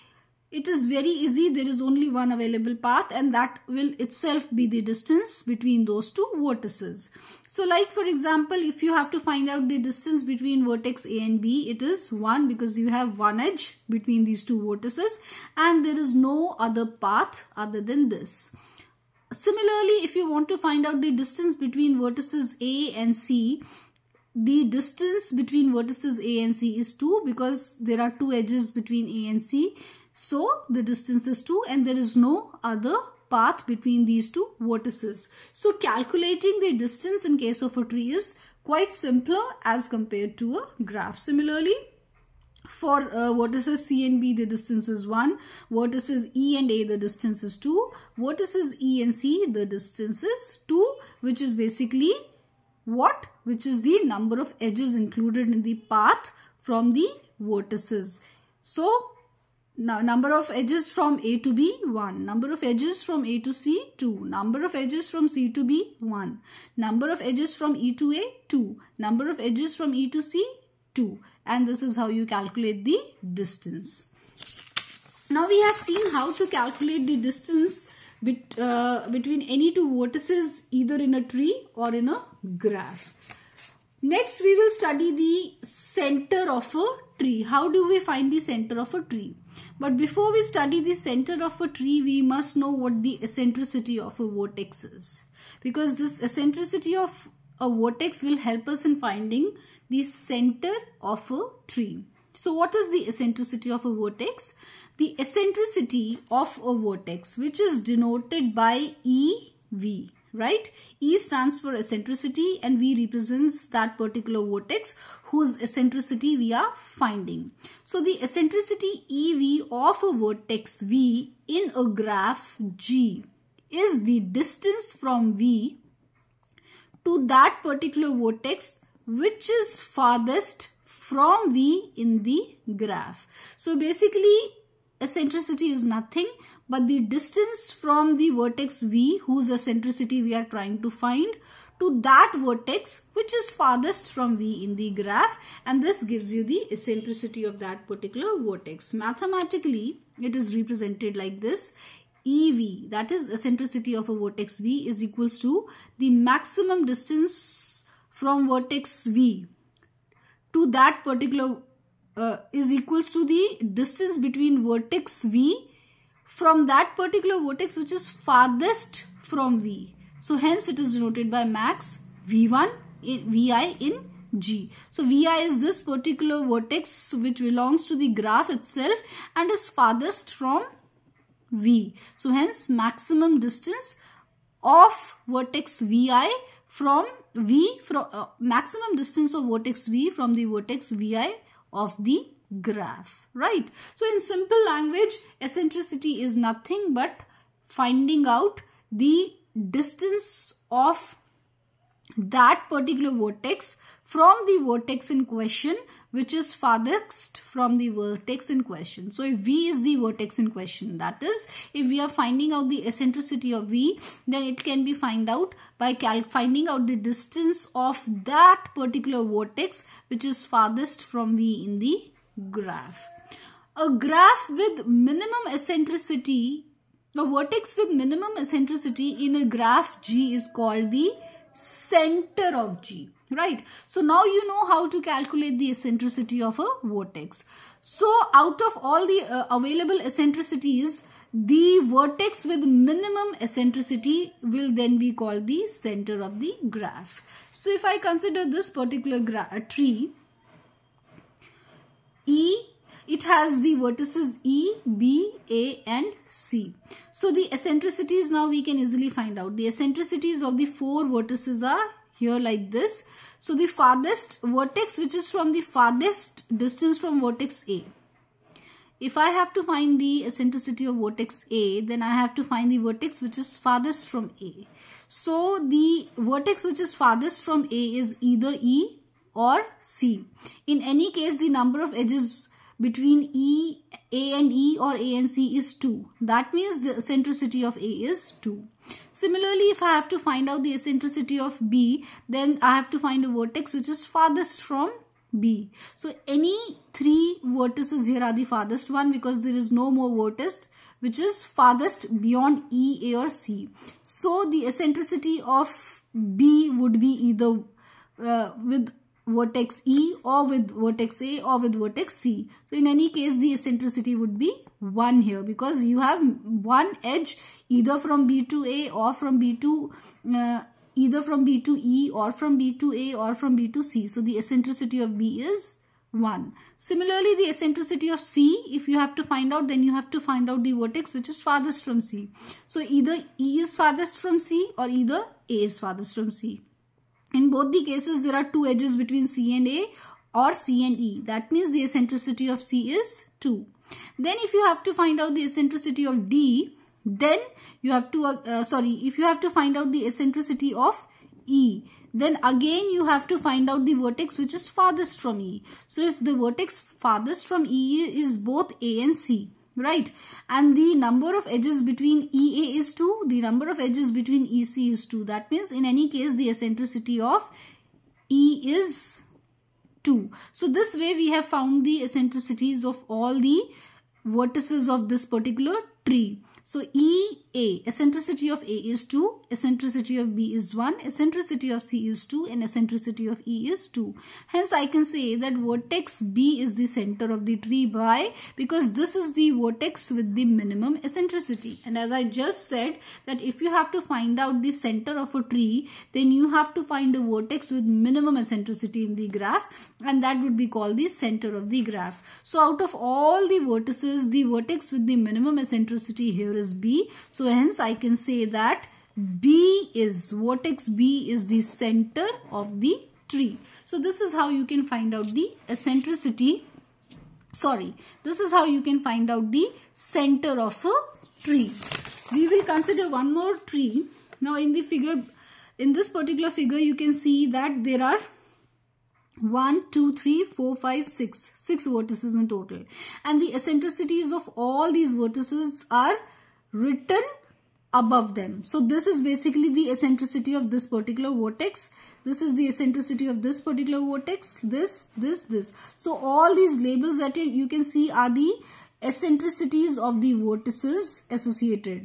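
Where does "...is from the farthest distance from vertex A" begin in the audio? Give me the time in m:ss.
4:25.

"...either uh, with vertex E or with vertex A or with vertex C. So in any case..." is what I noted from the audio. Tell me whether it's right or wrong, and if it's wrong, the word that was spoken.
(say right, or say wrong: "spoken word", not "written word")
right.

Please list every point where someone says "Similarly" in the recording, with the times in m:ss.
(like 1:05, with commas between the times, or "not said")
0:19, 0:41, 4:49, 5:26.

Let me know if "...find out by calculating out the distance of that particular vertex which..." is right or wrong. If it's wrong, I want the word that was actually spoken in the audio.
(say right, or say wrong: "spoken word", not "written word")
wrong: "finding", not "calculating".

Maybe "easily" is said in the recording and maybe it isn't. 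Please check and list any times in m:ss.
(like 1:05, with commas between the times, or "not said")
4:18.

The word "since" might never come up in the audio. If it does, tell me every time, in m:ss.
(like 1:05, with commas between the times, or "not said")
not said.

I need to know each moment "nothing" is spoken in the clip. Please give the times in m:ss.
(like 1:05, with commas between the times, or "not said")
2:15, 3:16.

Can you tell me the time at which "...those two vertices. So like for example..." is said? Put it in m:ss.
0:05.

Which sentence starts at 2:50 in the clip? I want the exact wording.
So hence it is denoted by max V1 in, VI in G.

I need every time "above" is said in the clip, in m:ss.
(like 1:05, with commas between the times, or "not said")
7:17.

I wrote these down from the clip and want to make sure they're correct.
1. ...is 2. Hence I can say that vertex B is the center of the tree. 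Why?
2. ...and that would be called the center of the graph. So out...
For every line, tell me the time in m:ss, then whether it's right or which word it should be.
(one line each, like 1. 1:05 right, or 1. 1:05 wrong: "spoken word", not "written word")
1. 6:23 right
2. 6:40 right.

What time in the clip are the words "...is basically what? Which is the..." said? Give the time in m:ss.
0:51.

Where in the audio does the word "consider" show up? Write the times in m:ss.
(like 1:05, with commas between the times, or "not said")
4:07, 7:02.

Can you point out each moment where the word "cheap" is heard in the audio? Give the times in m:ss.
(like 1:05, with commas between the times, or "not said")
not said.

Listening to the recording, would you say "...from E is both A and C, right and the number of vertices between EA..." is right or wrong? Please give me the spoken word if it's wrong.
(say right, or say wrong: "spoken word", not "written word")
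wrong: "edges", not "vertices".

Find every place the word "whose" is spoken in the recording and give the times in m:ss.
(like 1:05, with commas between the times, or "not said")
1:55, 2:19.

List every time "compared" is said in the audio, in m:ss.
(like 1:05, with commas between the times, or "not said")
0:39.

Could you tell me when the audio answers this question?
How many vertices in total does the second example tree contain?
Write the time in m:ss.
7:11.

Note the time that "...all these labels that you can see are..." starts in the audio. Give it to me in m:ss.
7:26.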